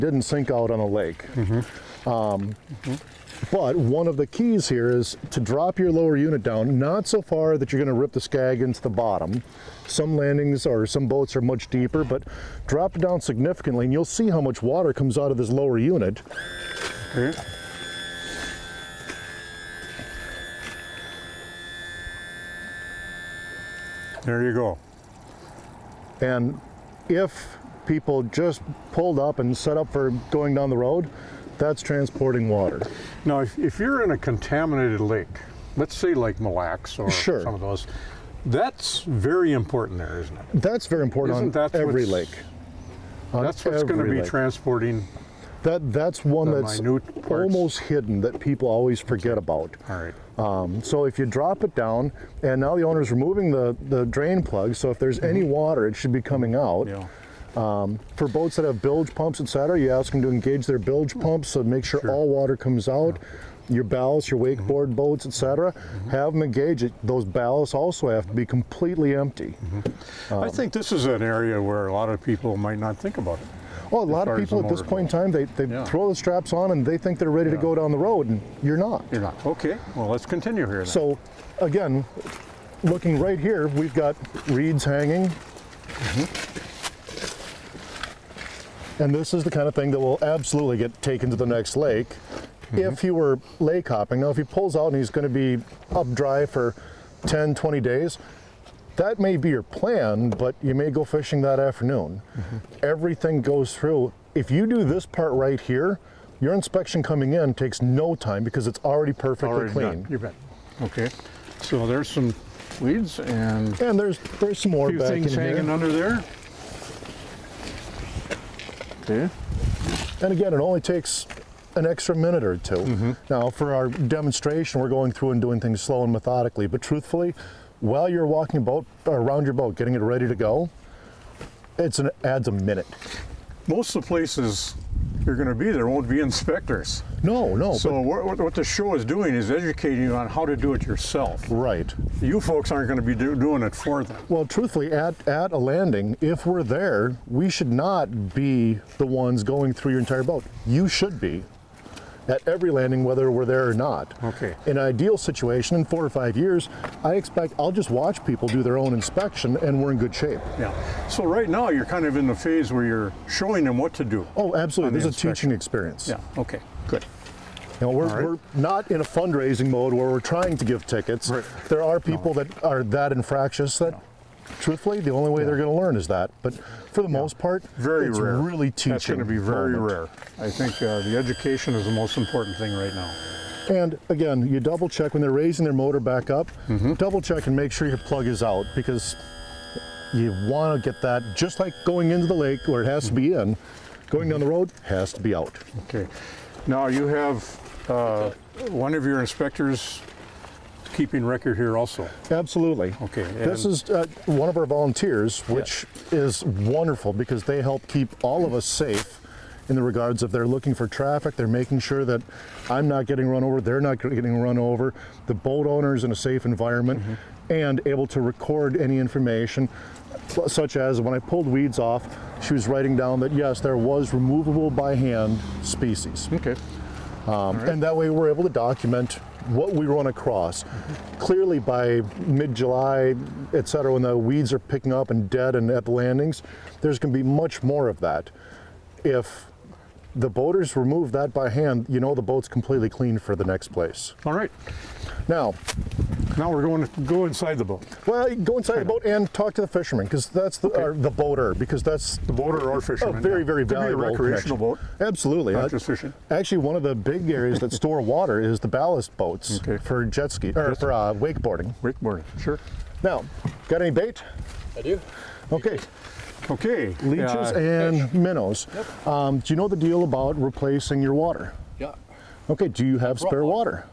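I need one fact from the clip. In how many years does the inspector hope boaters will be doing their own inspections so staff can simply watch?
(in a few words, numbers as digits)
4 or 5 years.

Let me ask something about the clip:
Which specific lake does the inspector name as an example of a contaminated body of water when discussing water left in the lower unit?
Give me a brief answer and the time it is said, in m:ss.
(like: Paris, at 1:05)
Lake Mille Lacs, at 0:36.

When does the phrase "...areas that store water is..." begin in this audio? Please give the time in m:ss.
4:17.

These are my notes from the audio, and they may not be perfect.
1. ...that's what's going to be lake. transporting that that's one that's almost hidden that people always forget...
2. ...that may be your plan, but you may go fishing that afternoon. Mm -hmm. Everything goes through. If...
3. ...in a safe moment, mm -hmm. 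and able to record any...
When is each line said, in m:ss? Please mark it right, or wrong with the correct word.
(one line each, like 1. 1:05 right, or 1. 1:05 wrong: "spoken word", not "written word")
1. 0:43 right
2. 1:38 right
3. 3:36 wrong: "environment", not "moment".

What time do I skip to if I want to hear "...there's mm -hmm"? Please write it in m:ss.
0:54.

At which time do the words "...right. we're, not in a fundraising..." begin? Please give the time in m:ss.
2:48.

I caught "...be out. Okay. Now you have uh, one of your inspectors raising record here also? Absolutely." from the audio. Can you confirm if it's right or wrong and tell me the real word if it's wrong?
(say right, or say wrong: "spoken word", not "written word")
wrong: "keeping", not "raising".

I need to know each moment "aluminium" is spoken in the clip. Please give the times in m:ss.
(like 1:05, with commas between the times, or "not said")
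not said.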